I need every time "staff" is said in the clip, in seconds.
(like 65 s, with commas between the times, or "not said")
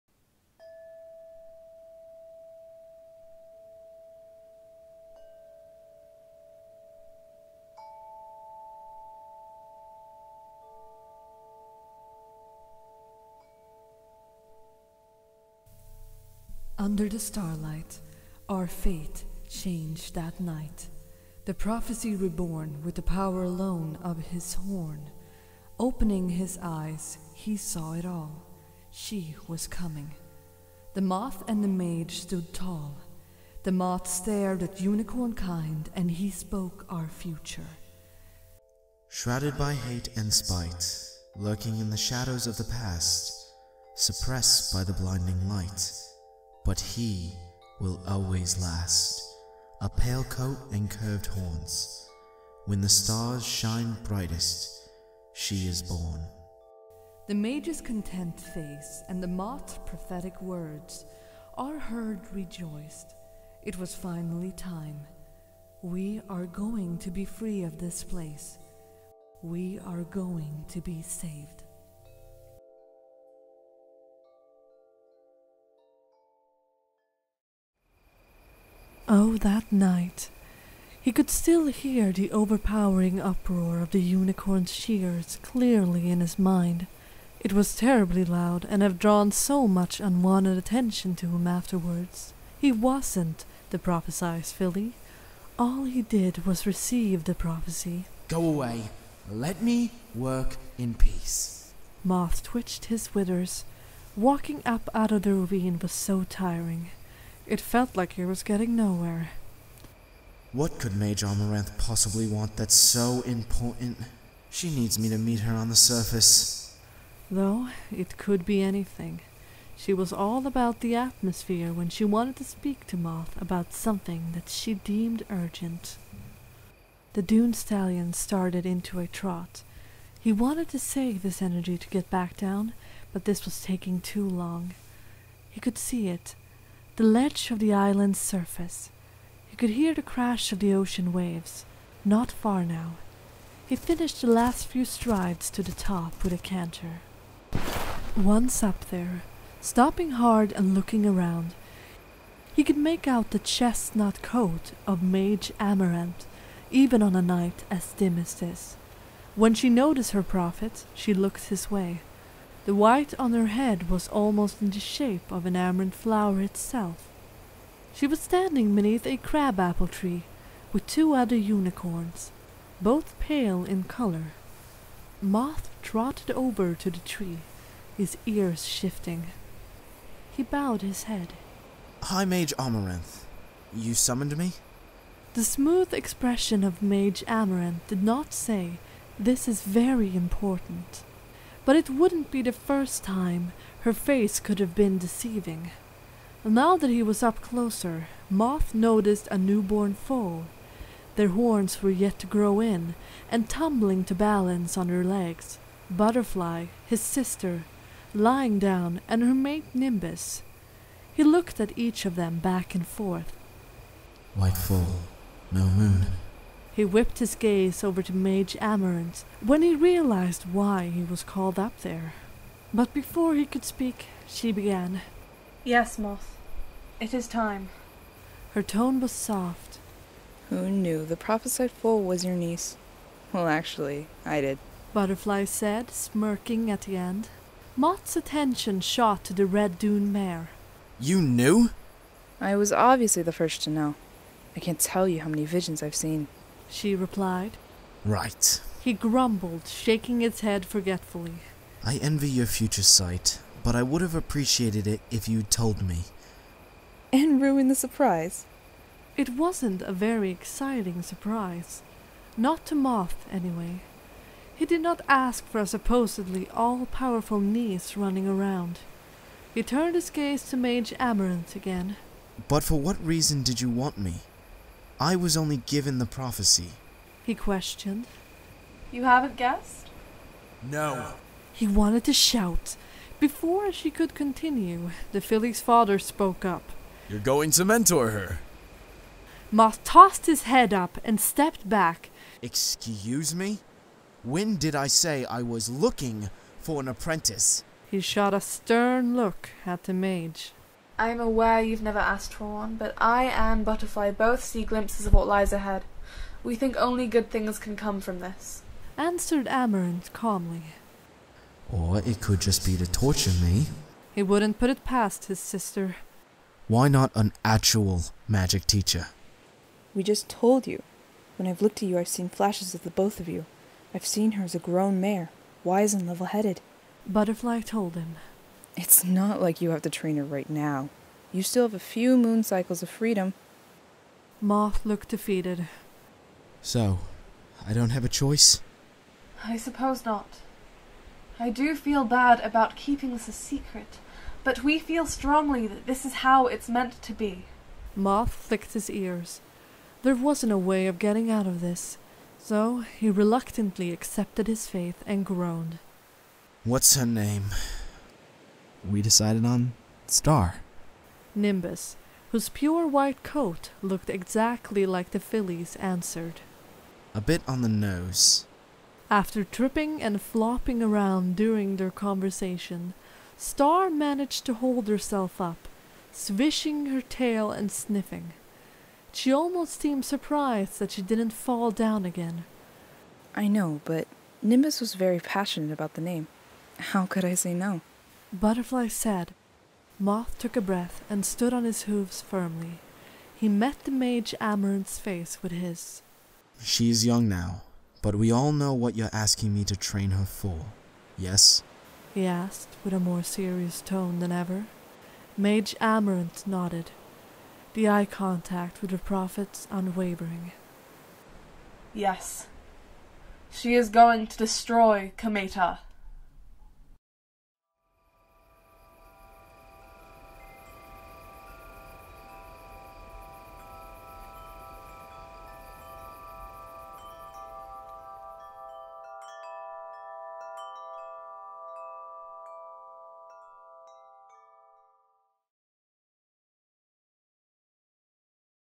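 not said.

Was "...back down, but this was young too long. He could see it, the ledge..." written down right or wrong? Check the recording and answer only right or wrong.
wrong.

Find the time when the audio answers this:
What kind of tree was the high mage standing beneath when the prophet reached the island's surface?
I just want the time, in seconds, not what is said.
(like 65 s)
169 s.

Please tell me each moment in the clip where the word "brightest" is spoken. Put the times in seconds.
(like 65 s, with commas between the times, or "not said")
54 s.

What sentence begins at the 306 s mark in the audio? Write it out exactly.
We think only good things can come from this.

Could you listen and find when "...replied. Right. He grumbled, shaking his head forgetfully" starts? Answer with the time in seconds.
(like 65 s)
246 s.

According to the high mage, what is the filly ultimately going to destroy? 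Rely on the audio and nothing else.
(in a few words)
Kameta.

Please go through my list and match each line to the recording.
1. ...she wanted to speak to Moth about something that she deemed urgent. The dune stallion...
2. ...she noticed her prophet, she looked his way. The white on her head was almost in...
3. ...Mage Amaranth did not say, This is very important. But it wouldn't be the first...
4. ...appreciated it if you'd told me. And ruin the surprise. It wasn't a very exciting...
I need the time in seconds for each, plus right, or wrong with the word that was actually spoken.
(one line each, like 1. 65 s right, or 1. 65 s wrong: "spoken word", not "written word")
1. 121 s right
2. 159 s right
3. 186 s right
4. 254 s right.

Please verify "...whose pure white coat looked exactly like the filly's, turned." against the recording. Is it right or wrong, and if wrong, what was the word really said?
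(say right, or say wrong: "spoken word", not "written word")
wrong: "answered", not "turned".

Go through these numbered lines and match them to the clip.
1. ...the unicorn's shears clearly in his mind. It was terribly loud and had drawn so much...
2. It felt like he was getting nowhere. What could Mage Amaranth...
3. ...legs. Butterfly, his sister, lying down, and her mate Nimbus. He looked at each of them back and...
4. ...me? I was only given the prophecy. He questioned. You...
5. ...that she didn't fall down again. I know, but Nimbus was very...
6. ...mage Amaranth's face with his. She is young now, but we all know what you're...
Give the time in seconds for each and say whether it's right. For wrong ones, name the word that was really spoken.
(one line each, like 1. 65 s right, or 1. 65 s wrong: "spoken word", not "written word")
1. 83 s right
2. 107 s right
3. 205 s right
4. 273 s right
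5. 380 s right
6. 393 s right.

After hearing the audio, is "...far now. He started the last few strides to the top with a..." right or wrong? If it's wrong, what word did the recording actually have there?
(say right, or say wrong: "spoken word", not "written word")
wrong: "finished", not "started".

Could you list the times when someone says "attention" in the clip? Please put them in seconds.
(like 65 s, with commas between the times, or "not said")
90 s, 238 s.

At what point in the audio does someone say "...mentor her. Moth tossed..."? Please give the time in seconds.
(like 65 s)
287 s.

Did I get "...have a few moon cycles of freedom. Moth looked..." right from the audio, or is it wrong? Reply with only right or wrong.
right.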